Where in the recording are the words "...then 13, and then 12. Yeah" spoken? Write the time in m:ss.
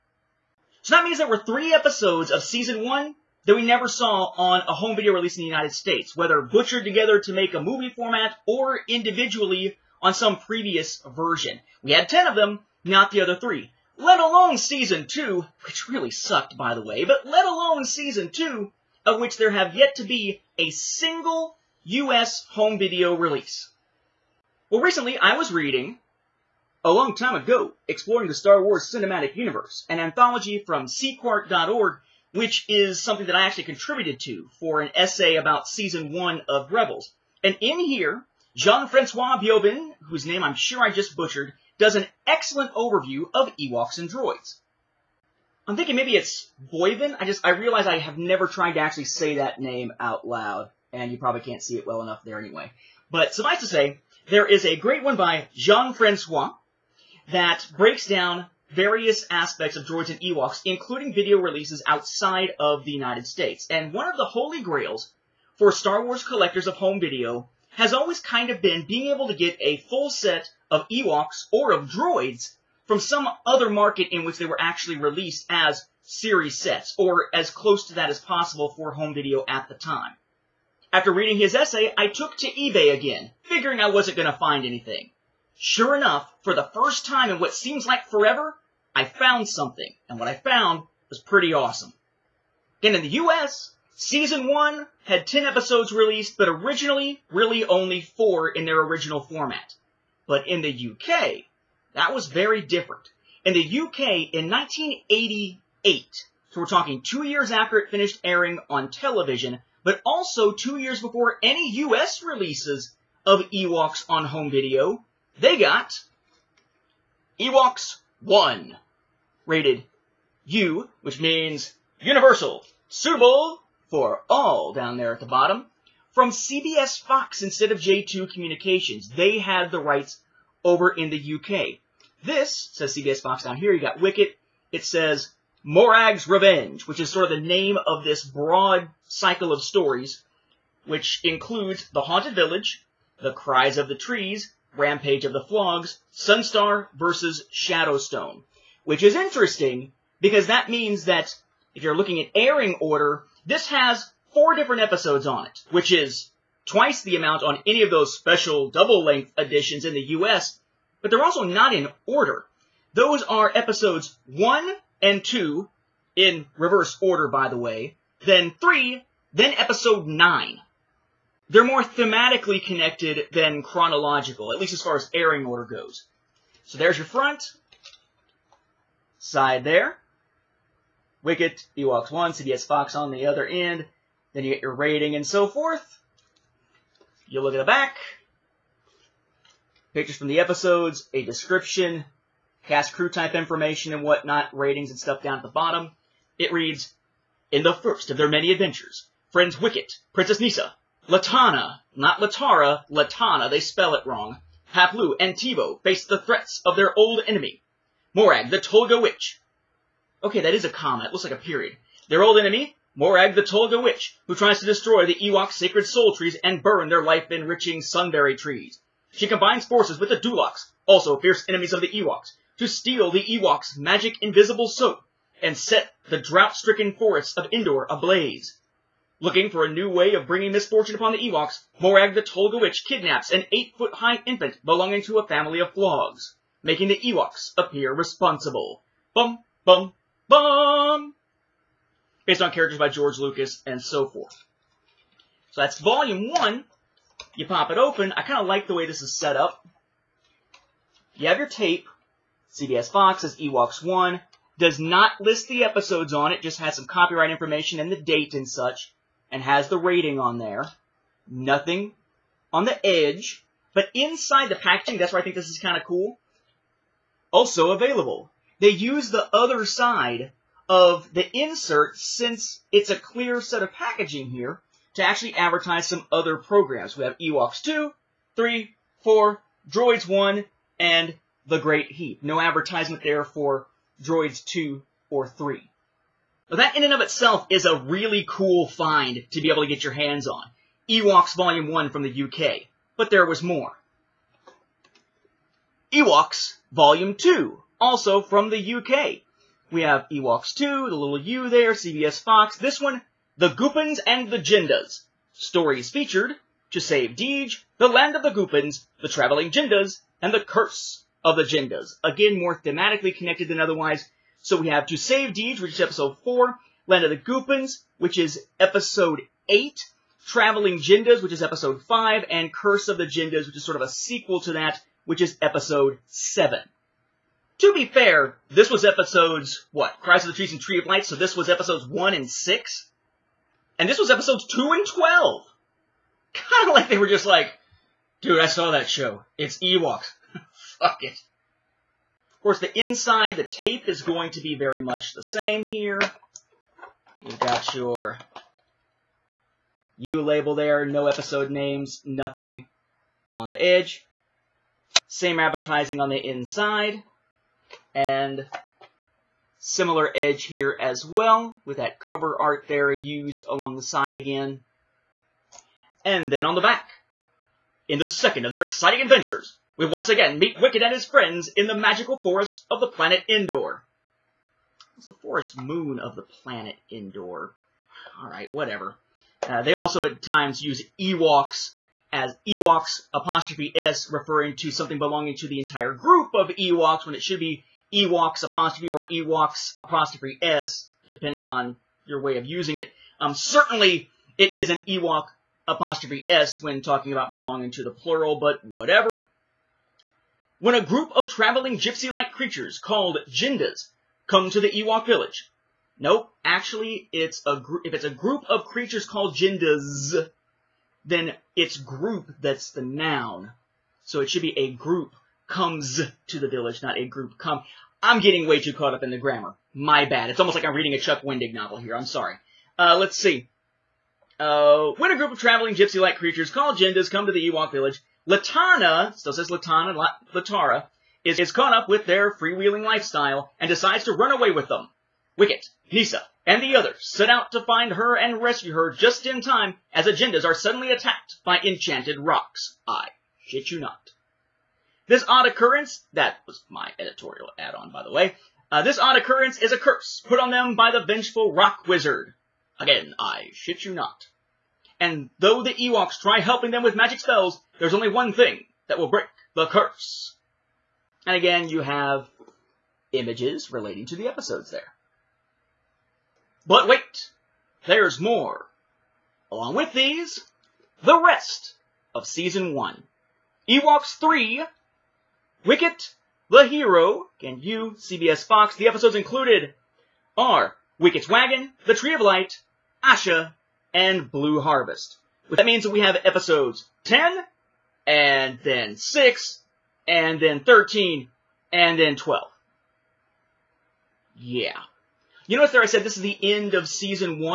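8:10.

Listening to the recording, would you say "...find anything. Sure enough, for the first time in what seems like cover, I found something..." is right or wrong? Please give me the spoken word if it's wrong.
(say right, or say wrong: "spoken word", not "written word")
wrong: "forever", not "cover".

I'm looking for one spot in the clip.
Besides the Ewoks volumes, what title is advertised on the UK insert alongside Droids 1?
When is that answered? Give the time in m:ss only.
4:41.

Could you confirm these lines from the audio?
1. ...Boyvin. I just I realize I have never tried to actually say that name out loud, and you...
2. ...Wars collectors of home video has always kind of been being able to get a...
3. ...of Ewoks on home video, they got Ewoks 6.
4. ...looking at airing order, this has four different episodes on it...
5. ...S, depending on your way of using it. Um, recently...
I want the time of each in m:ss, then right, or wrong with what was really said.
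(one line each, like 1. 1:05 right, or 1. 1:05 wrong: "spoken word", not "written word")
1. 0:46 right
2. 1:06 right
3. 1:53 wrong: "1", not "6"
4. 2:31 right
5. 6:30 wrong: "certainly", not "recently".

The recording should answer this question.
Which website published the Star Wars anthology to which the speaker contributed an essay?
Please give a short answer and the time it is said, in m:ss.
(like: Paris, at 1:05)
Sequart.org, at 0:30.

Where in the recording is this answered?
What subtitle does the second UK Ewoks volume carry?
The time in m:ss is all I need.
5:03.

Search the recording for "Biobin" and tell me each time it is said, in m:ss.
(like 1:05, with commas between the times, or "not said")
0:39.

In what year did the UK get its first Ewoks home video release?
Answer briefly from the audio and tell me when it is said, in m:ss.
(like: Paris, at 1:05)
1988, at 1:44.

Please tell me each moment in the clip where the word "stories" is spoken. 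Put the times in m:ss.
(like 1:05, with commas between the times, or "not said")
2:19, 5:05.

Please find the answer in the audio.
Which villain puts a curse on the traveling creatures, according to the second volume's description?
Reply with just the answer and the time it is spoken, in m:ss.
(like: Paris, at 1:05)
Rock wizard, at 7:31.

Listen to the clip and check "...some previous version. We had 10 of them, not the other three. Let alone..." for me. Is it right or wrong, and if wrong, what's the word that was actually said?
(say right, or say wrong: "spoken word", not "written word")
right.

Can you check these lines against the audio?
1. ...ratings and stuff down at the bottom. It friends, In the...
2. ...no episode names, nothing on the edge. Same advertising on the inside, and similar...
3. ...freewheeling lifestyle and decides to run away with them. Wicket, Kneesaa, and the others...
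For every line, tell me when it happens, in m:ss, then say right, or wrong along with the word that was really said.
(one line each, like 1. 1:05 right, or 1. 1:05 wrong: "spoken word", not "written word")
1. 3:14 wrong: "reads", not "friends"
2. 5:50 right
3. 7:12 right.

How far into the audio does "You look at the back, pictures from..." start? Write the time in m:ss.
3:07.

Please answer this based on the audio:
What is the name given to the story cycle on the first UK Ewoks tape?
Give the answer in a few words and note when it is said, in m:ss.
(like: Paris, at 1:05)
Morag's Revenge, at 2:15.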